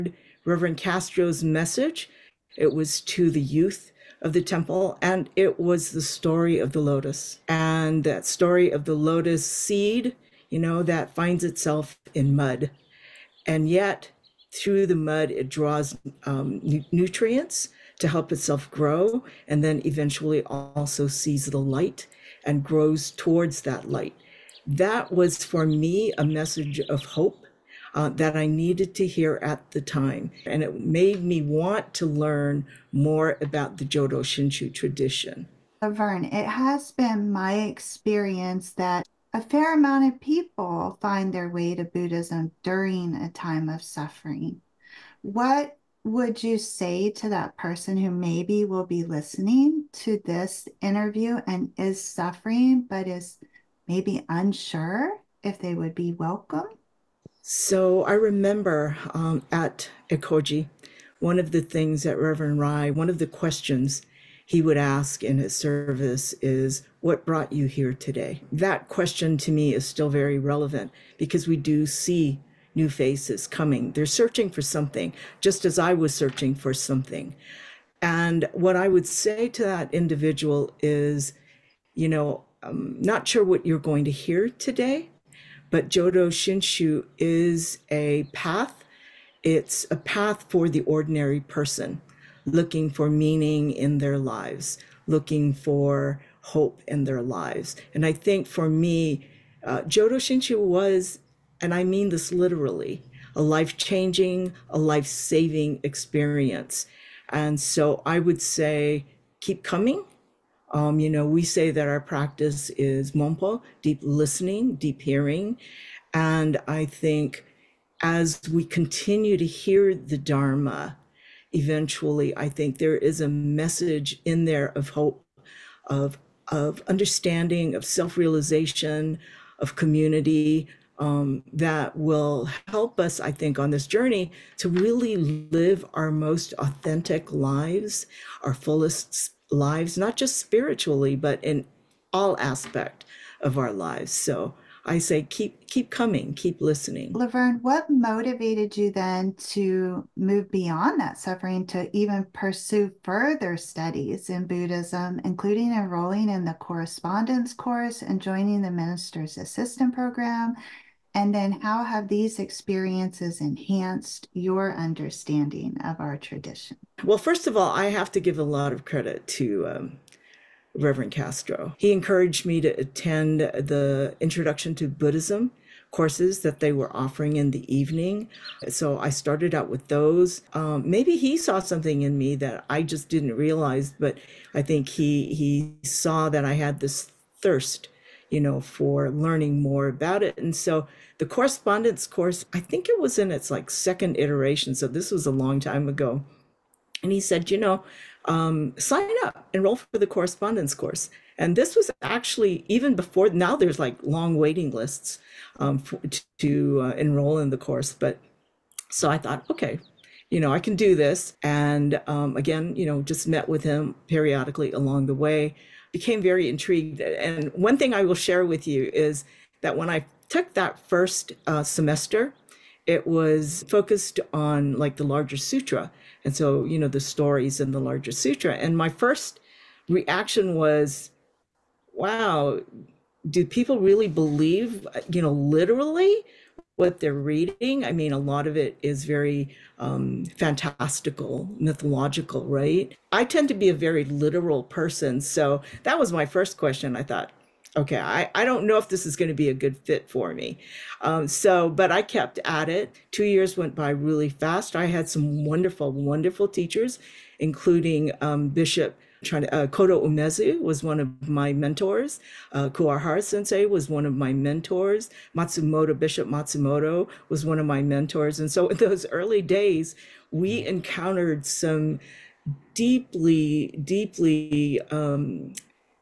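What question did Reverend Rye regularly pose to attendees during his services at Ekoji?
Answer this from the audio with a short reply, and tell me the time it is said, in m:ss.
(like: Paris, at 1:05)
What brought you here today?, at 1:07.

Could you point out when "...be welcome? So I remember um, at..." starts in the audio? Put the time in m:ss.
0:55.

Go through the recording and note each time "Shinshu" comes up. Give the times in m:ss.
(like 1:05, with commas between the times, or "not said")
0:34, 1:26, 1:40.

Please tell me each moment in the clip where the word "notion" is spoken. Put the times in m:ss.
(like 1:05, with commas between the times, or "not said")
not said.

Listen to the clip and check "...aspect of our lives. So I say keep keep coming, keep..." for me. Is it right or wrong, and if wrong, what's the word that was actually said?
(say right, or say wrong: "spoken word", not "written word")
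right.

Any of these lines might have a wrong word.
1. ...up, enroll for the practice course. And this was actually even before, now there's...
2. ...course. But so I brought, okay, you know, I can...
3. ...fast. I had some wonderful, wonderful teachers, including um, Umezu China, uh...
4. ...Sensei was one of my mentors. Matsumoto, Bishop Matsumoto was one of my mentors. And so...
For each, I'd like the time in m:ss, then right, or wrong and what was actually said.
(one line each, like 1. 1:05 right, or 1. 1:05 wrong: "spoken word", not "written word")
1. 3:19 wrong: "correspondence", not "practice"
2. 3:27 wrong: "thought", not "brought"
3. 4:14 wrong: "Bishop", not "Umezu"
4. 4:23 right.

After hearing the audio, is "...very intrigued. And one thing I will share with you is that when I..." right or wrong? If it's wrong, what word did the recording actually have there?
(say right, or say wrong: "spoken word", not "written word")
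right.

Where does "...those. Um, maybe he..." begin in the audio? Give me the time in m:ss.
2:59.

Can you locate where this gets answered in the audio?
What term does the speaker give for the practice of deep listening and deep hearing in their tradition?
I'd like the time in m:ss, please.
1:53.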